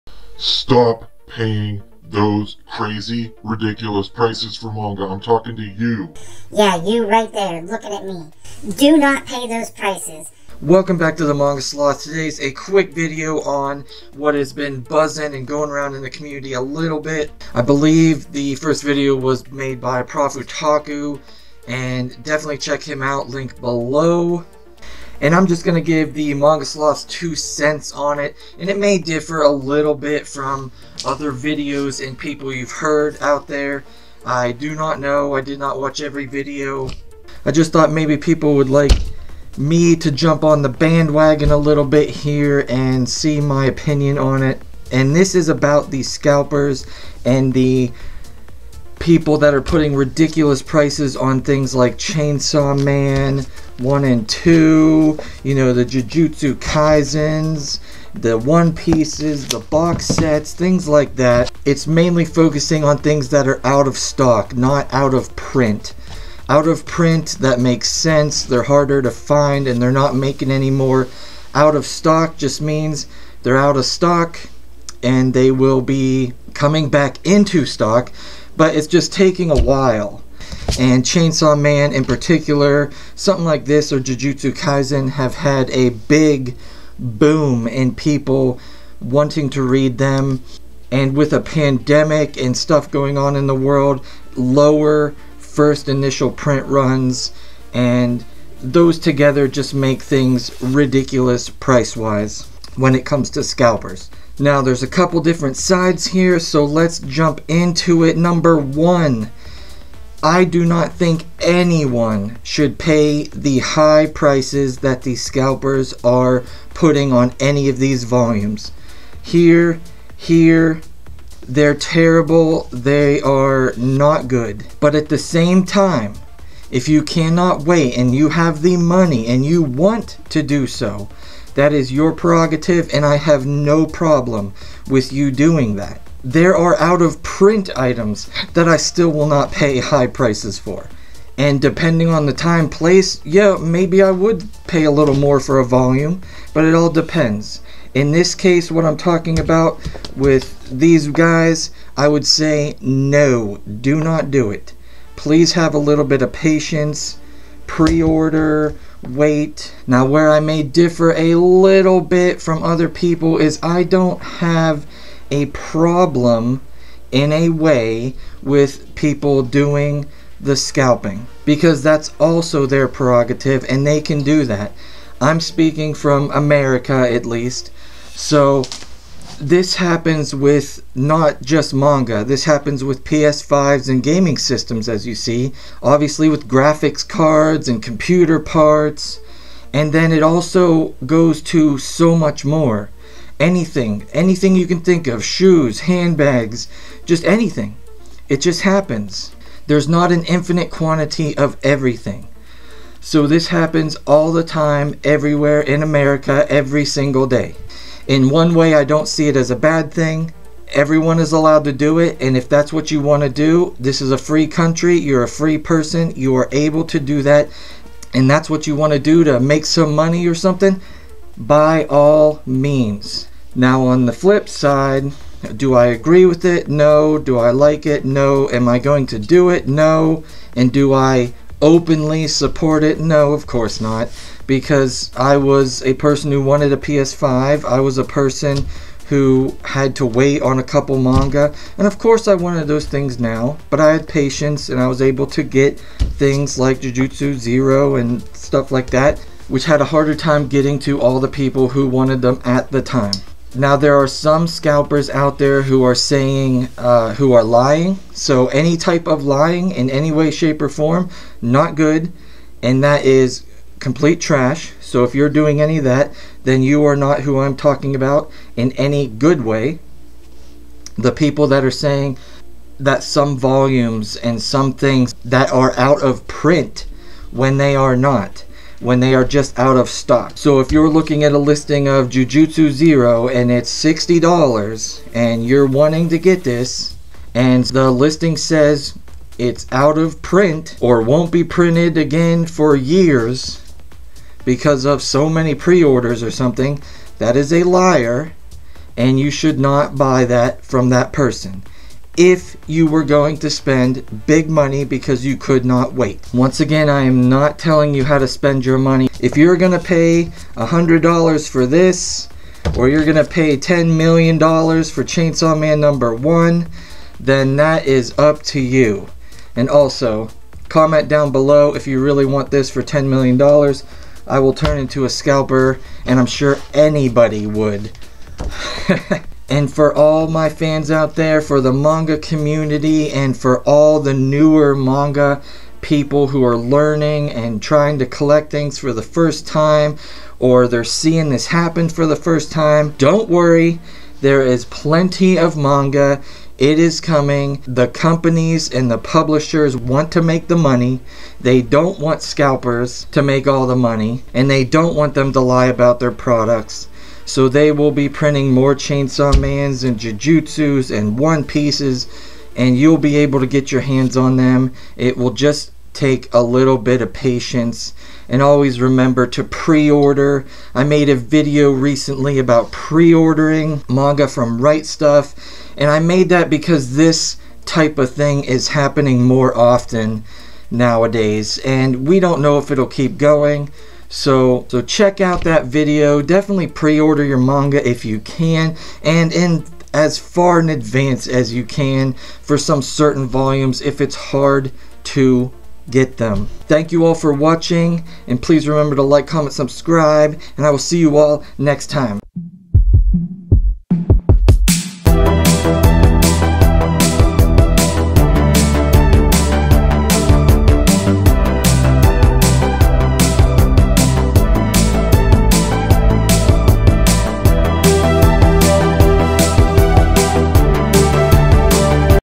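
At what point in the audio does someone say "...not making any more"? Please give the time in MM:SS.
01:09.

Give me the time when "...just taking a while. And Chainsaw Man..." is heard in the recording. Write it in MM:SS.
01:18.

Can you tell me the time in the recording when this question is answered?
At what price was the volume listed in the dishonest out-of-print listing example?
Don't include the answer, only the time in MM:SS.
04:43.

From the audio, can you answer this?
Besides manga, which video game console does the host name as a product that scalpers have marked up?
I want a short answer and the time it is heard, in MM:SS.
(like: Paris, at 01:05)
PS5, at 03:03.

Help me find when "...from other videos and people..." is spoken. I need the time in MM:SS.
00:30.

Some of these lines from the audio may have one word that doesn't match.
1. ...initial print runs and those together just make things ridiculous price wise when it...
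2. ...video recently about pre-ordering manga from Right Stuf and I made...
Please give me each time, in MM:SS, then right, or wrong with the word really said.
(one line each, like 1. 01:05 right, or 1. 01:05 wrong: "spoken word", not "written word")
1. 01:35 right
2. 06:11 right.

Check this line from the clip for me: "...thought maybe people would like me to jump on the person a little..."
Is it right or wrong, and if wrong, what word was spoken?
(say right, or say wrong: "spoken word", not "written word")
wrong: "bandwagon", not "person".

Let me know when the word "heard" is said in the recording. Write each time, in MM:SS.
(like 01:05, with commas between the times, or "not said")
00:32.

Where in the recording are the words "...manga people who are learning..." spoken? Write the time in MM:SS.
05:34.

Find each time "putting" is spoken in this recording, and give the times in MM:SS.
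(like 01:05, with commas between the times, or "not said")
00:49, 01:56.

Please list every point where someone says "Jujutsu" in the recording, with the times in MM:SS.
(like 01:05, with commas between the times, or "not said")
00:55, 01:23, 04:06, 04:42, 05:59.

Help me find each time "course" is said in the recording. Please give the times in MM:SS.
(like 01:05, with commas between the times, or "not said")
03:53, 04:01.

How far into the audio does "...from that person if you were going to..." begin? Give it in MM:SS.
05:00.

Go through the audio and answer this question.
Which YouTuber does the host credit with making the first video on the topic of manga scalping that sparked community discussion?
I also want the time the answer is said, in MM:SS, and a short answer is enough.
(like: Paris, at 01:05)
ProfOtaku, at 00:20.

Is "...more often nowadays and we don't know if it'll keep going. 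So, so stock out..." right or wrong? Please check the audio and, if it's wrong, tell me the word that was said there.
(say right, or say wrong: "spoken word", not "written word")
wrong: "check", not "stock".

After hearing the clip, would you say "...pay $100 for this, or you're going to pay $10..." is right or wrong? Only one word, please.
right.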